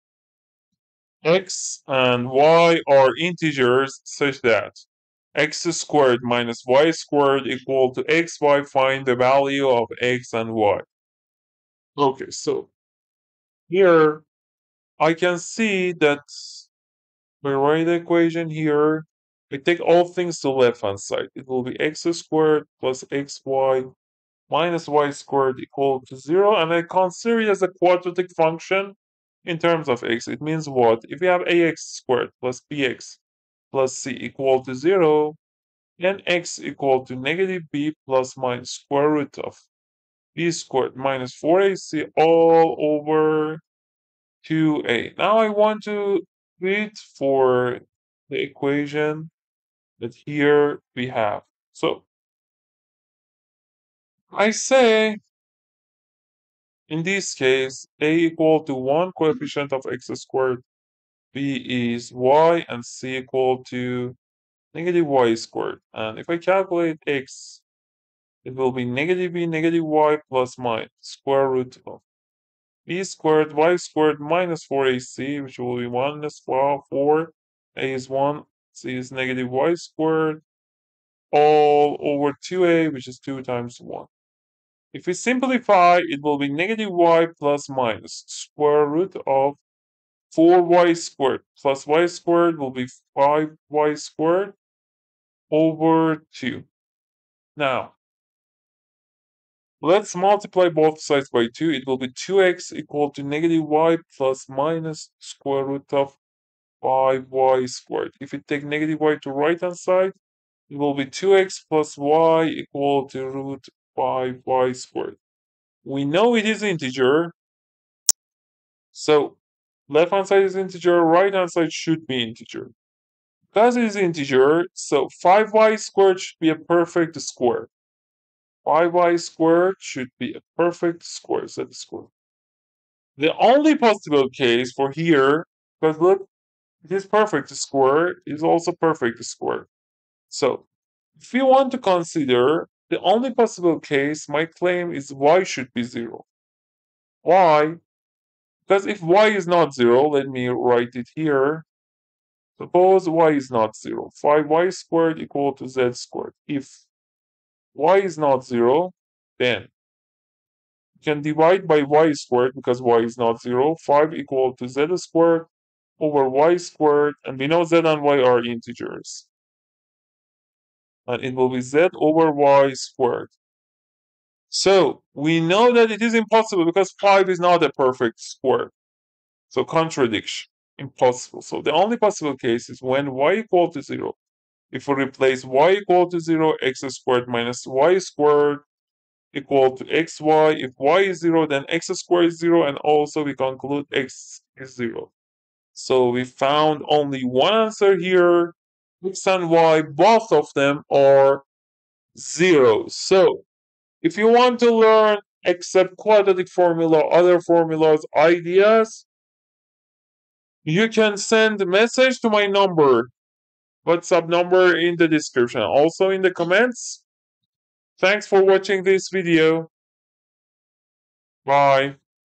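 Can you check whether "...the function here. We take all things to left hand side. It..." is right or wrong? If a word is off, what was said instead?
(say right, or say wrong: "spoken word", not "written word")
wrong: "equation", not "function".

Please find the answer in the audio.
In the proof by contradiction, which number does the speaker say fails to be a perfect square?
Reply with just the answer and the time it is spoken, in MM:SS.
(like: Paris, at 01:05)
5, at 02:56.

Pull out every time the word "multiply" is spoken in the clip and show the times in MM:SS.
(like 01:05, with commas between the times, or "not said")
01:40.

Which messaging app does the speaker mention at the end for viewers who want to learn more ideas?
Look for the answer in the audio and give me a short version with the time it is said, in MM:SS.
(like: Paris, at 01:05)
WhatsApp, at 03:33.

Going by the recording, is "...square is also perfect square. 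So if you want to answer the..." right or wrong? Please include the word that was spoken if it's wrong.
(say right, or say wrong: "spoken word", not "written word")
wrong: "consider", not "answer".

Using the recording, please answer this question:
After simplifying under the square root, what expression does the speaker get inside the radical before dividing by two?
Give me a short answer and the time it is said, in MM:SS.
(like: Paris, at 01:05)
5y squared, at 01:33.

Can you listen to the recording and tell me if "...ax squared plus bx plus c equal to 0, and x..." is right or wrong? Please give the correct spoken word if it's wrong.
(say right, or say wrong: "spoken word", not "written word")
right.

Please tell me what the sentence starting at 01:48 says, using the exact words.
If we take negative y to right hand side, it will be 2x plus y equal to root 5y squared.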